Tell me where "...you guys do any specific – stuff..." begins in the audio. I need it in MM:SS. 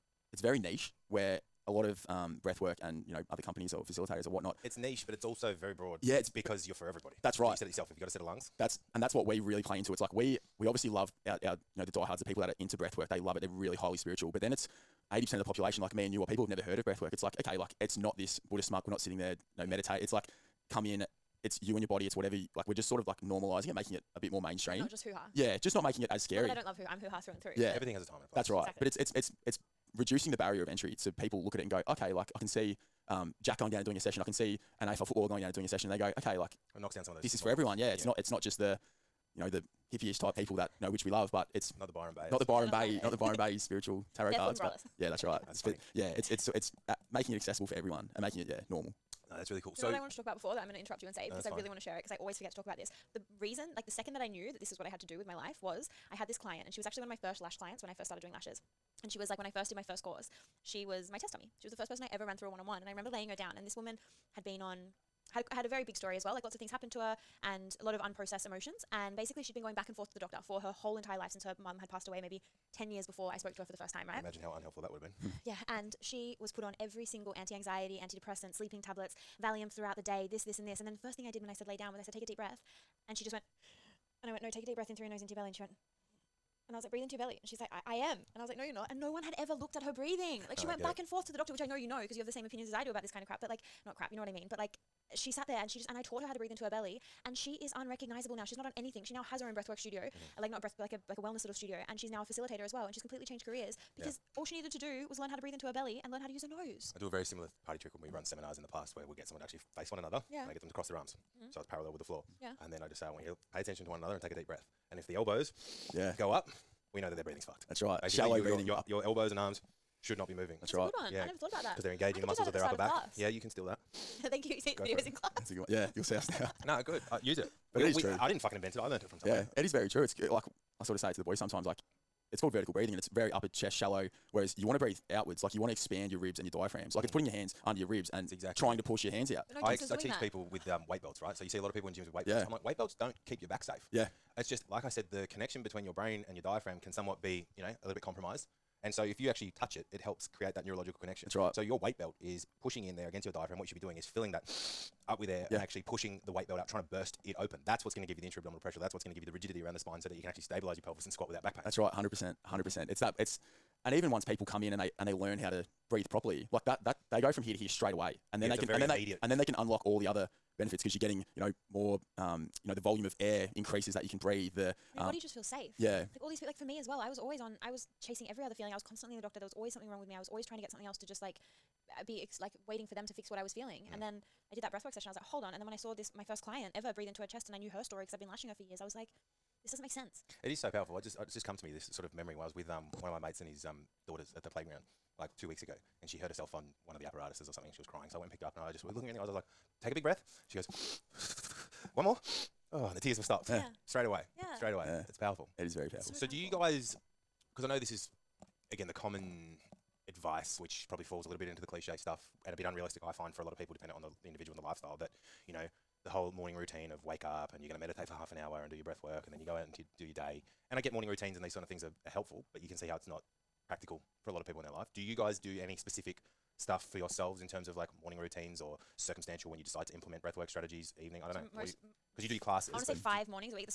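03:44.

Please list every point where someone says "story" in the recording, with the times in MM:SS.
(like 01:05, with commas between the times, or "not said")
01:05, 03:07.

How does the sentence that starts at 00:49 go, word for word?
so know what I wanted to talk about before that I'm going to interrupt you and say no, because I fine.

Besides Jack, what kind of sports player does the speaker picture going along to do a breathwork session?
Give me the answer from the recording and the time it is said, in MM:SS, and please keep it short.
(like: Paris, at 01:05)
AFL footballer, at 00:34.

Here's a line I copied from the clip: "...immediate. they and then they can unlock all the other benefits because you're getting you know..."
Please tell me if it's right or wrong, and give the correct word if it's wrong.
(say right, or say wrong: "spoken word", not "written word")
right.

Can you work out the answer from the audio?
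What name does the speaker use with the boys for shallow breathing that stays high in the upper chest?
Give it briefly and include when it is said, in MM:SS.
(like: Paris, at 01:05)
vertical breathing, at 02:12.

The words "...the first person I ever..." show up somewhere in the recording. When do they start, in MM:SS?
01:01.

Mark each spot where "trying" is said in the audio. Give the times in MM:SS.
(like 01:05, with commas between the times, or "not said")
02:18, 02:36, 03:00.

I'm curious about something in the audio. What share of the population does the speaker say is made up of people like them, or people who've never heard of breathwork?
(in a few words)
80%.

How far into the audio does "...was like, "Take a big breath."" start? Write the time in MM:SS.
03:19.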